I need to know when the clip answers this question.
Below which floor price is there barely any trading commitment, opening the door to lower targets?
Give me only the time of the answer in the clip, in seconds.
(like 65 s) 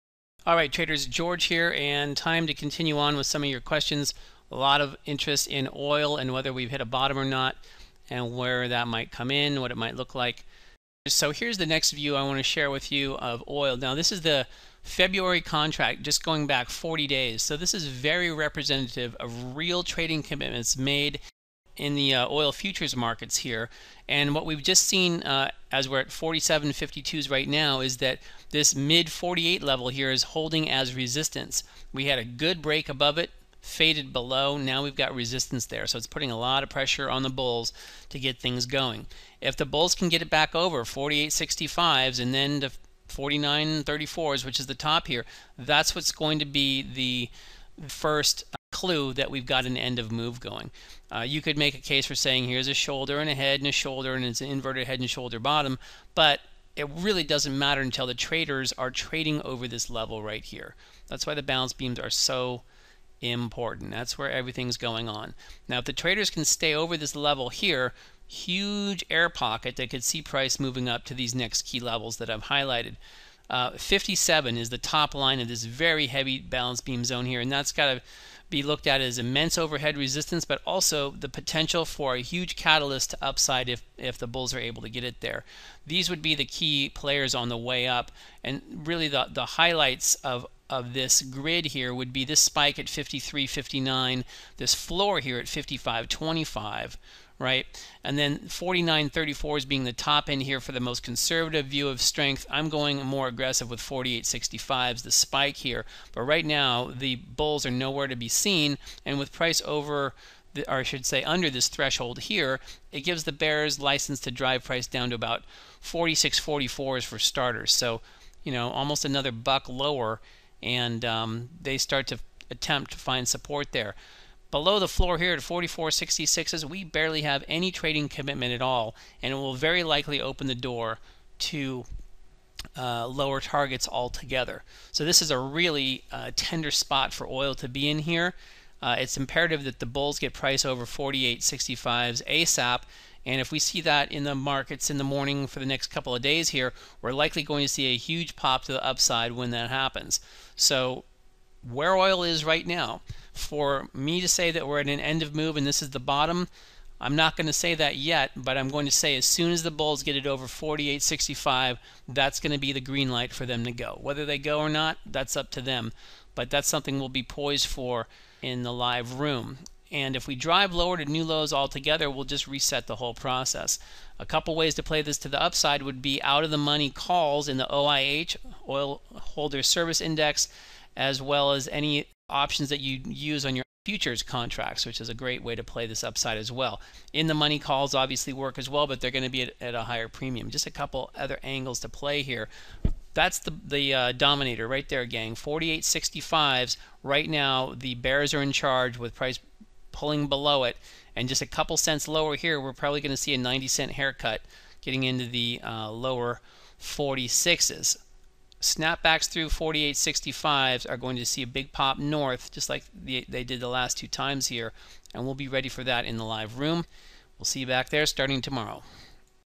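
125 s.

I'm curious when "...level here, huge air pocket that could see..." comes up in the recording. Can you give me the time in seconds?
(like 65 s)
67 s.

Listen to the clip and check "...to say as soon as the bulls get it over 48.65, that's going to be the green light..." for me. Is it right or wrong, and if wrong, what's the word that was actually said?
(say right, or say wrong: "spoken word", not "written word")
right.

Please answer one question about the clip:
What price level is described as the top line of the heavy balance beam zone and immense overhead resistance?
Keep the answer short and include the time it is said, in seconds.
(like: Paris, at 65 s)
57, at 73 s.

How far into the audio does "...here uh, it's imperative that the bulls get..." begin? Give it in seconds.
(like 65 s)
137 s.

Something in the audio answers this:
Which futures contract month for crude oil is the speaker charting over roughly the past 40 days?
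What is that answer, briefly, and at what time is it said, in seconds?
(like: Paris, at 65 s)
February, at 14 s.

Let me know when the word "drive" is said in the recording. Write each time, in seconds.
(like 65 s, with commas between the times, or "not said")
114 s, 170 s.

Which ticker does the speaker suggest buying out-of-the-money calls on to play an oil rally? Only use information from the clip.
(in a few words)
OIH.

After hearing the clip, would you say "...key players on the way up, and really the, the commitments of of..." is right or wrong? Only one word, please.
wrong.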